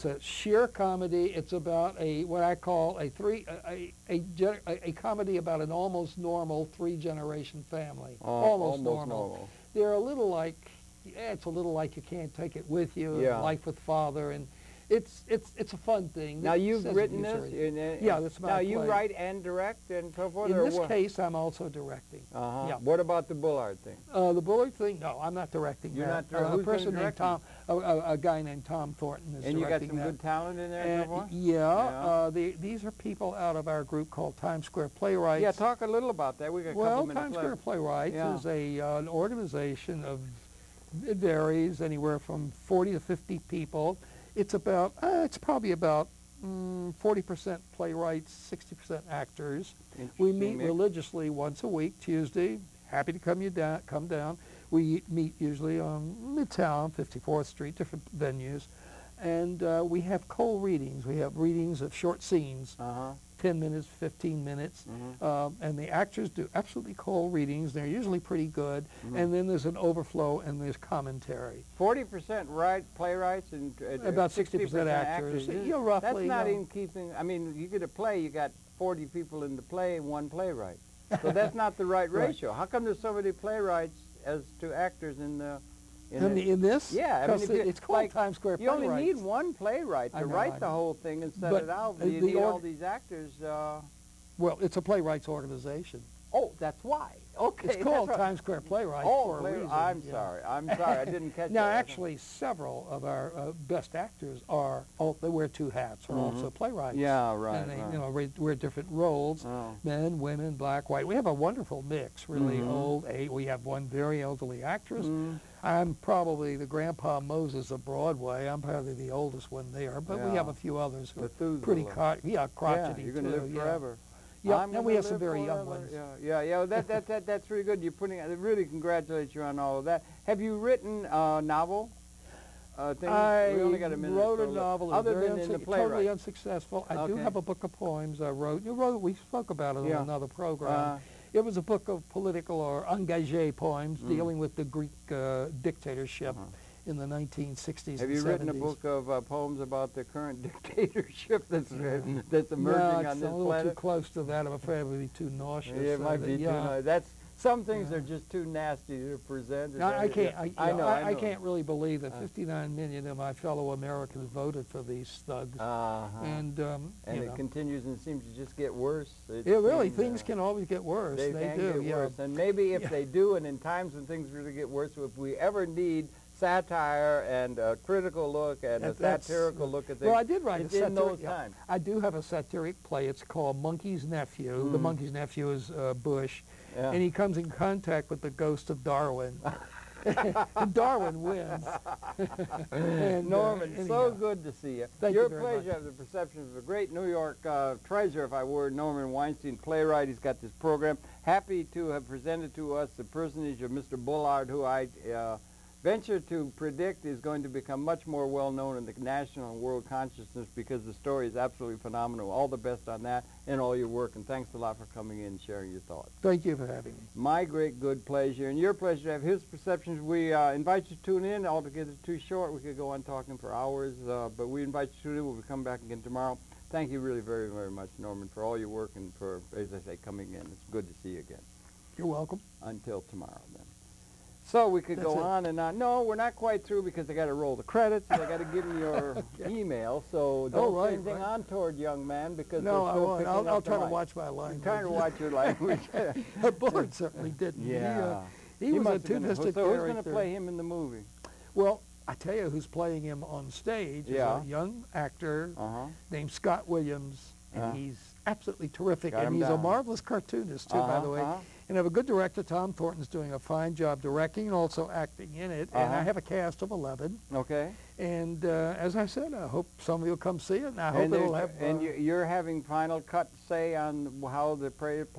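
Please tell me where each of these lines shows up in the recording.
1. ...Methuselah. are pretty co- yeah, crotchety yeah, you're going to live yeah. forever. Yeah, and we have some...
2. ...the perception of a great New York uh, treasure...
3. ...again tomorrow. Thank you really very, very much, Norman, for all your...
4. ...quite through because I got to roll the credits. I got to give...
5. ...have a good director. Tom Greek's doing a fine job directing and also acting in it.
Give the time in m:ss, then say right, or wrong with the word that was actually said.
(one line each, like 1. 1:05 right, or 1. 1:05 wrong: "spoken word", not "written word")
1. 2:01 right
2. 3:15 right
3. 3:45 right
4. 3:56 right
5. 4:21 wrong: "Thornton", not "Greek".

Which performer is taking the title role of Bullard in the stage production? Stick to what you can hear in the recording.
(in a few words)
Scott Williams.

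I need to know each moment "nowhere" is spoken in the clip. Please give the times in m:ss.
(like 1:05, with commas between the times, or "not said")
not said.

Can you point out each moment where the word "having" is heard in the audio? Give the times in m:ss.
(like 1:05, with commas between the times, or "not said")
3:36, 4:32.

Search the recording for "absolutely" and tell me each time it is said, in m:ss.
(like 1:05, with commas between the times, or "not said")
1:06, 3:31, 4:18.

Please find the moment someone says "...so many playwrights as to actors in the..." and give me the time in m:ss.
1:23.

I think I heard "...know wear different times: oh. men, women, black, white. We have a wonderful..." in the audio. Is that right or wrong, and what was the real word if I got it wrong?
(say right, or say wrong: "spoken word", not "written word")
wrong: "roles", not "times".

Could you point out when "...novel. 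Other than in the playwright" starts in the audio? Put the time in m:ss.
2:14.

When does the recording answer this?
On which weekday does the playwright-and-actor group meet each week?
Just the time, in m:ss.
0:51.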